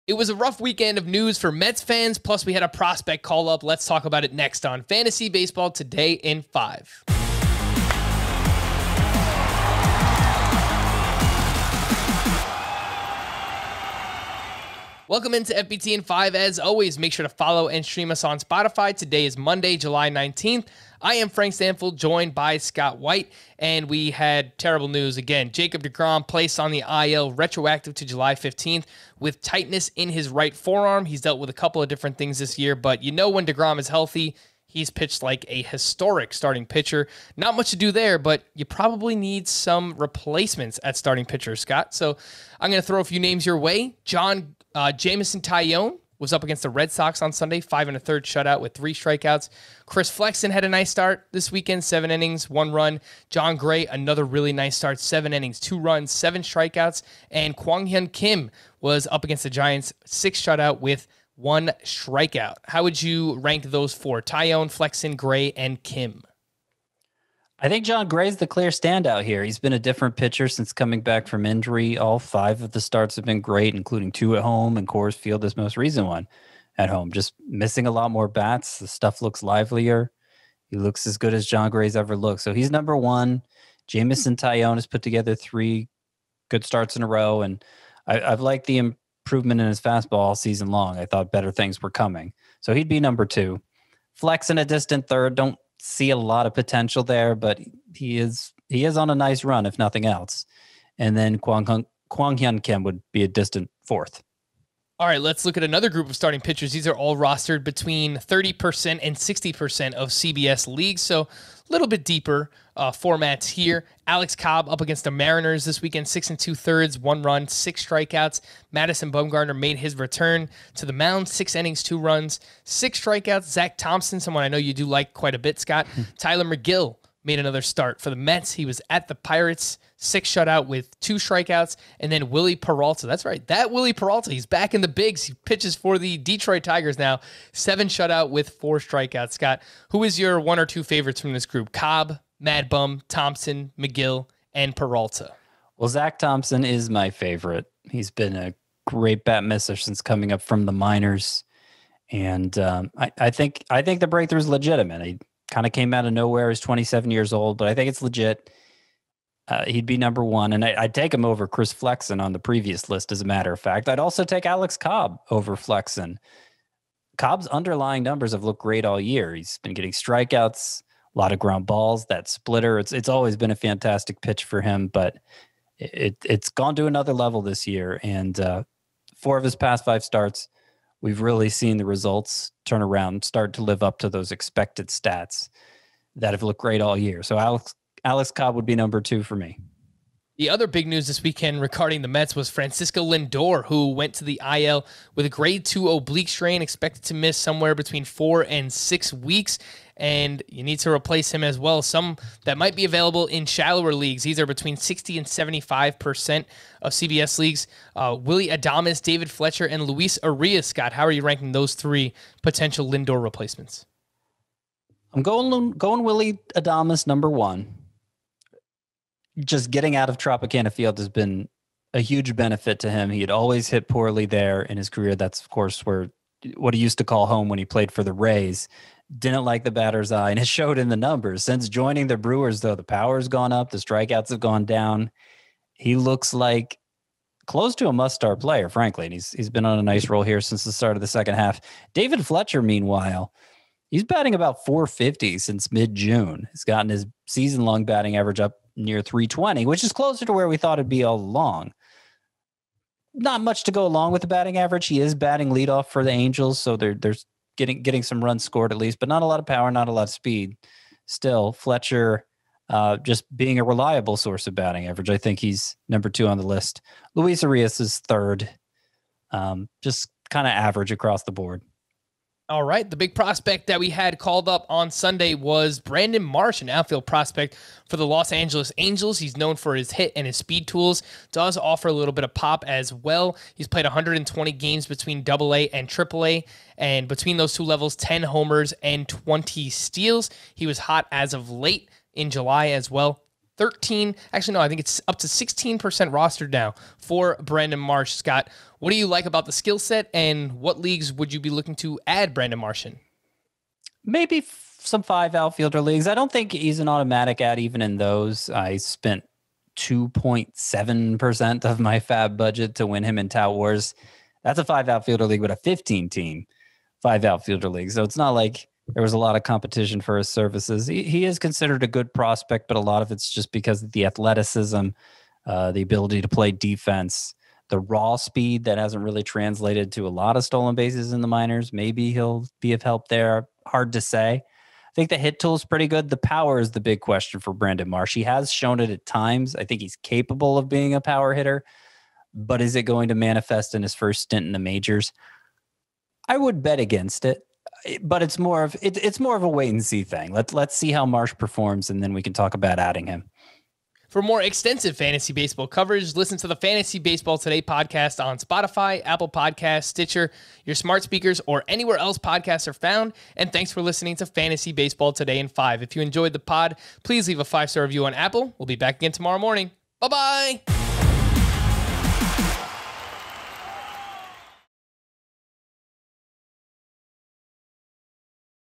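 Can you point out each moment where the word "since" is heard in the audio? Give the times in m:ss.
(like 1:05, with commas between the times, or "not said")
1:10, 2:29, 3:51, 4:00, 4:05.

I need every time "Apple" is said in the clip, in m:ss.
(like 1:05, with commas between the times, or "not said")
5:59, 6:08.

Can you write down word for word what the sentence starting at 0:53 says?
Jon Gray, another really nice start, seven innings, two runs, seven strikeouts.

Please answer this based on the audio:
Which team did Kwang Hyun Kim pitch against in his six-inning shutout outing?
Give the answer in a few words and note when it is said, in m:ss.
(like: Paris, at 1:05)
Giants, at 0:59.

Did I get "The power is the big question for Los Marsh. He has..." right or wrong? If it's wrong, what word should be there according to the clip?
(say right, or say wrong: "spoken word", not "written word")
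wrong: "Brandon", not "Los".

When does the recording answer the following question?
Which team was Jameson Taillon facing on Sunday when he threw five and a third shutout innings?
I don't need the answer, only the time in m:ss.
0:46.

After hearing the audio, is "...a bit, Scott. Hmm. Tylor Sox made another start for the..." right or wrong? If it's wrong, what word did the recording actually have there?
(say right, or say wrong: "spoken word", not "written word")
wrong: "Megill", not "Sox".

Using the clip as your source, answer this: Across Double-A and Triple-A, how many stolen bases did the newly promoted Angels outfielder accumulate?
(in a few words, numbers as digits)
20.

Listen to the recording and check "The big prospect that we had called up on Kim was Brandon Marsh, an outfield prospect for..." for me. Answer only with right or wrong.
wrong.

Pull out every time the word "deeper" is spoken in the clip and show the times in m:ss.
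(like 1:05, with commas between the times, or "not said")
1:52.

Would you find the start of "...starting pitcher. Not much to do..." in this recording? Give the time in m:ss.
0:36.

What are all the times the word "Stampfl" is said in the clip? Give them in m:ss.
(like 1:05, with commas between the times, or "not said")
0:21.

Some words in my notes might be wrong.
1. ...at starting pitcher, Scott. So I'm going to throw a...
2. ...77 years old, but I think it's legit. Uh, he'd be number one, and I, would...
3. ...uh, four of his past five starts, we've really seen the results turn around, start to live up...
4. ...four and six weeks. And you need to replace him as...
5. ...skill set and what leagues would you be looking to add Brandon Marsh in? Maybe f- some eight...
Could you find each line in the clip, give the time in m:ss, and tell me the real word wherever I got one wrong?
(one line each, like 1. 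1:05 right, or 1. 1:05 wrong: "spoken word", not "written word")
1. 0:40 right
2. 2:36 wrong: "27", not "77"
3. 2:58 right
4. 3:18 right
5. 4:59 wrong: "five", not "eight".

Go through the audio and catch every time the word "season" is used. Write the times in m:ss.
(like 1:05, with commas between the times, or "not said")
1:30, 4:07.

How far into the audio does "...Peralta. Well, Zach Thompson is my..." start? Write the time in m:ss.
2:24.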